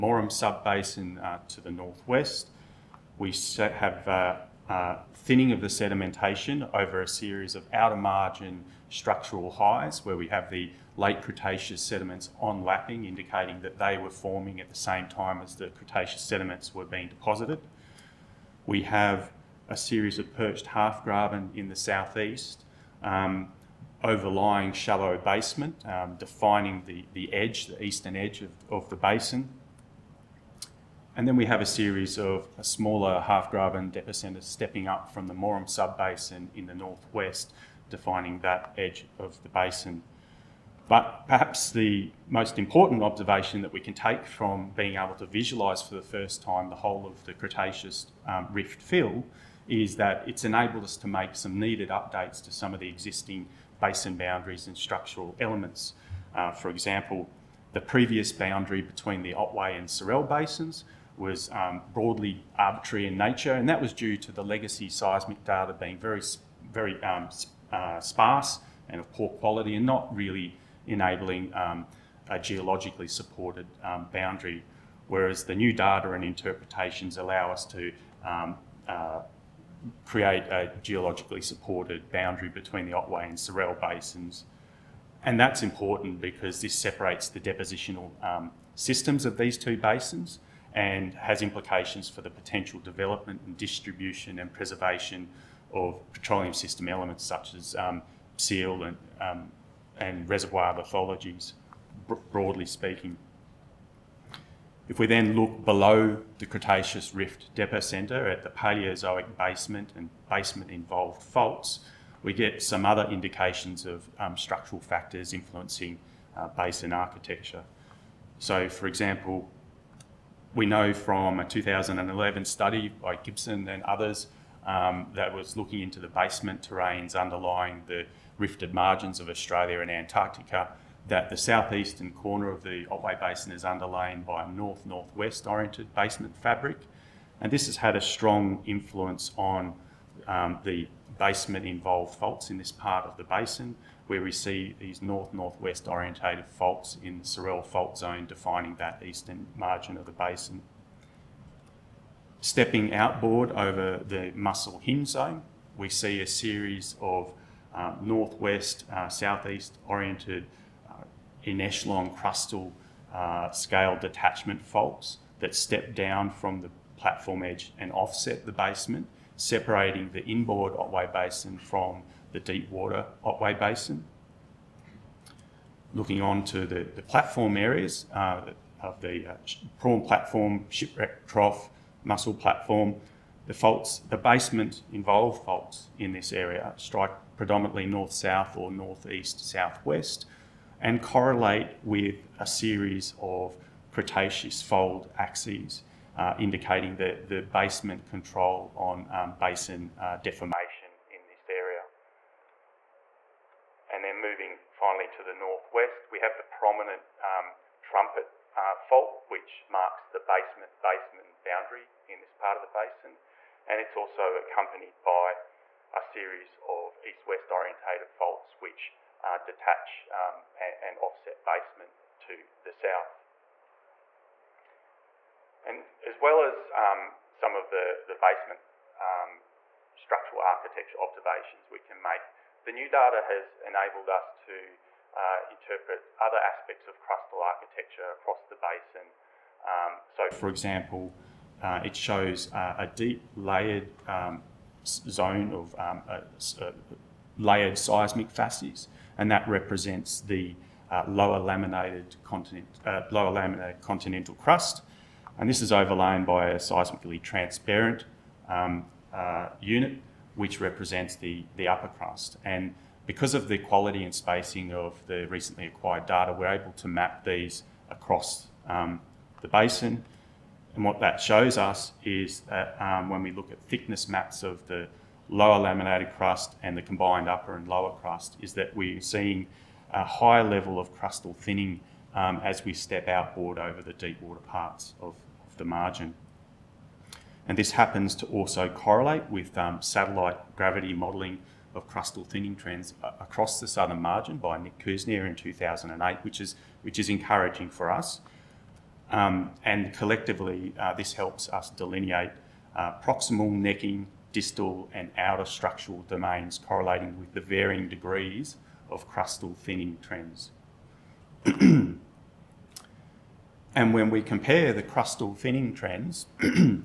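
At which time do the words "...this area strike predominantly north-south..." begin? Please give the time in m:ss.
3:06.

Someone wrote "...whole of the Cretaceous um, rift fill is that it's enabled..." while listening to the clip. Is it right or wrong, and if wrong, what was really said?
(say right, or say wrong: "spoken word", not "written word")
right.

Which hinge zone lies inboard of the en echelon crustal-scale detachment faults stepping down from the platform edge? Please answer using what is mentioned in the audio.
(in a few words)
Mussel Hinge zone.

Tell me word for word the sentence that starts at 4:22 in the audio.
And because of the quality and spacing of the recently acquired data, we're able to map these across um, the basin.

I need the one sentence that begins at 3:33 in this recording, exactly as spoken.
And it's also accompanied by a series of east-west orientated faults, which uh, detach um, and, and, offset basement to the south.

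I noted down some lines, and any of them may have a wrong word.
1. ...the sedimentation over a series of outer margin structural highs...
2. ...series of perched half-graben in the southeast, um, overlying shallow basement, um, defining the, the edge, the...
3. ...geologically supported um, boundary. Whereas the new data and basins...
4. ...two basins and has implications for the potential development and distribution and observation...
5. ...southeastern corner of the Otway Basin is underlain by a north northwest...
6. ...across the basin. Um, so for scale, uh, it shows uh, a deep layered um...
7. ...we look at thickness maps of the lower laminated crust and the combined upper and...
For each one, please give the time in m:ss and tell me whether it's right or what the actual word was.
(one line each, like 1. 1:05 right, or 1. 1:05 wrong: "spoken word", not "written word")
1. 0:05 right
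2. 0:19 right
3. 1:12 wrong: "interpretations", not "basins"
4. 1:29 wrong: "preservation", not "observation"
5. 2:11 right
6. 3:58 wrong: "example", not "scale"
7. 4:33 right.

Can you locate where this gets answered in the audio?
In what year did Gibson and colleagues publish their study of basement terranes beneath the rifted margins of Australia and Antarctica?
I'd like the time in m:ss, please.
2:01.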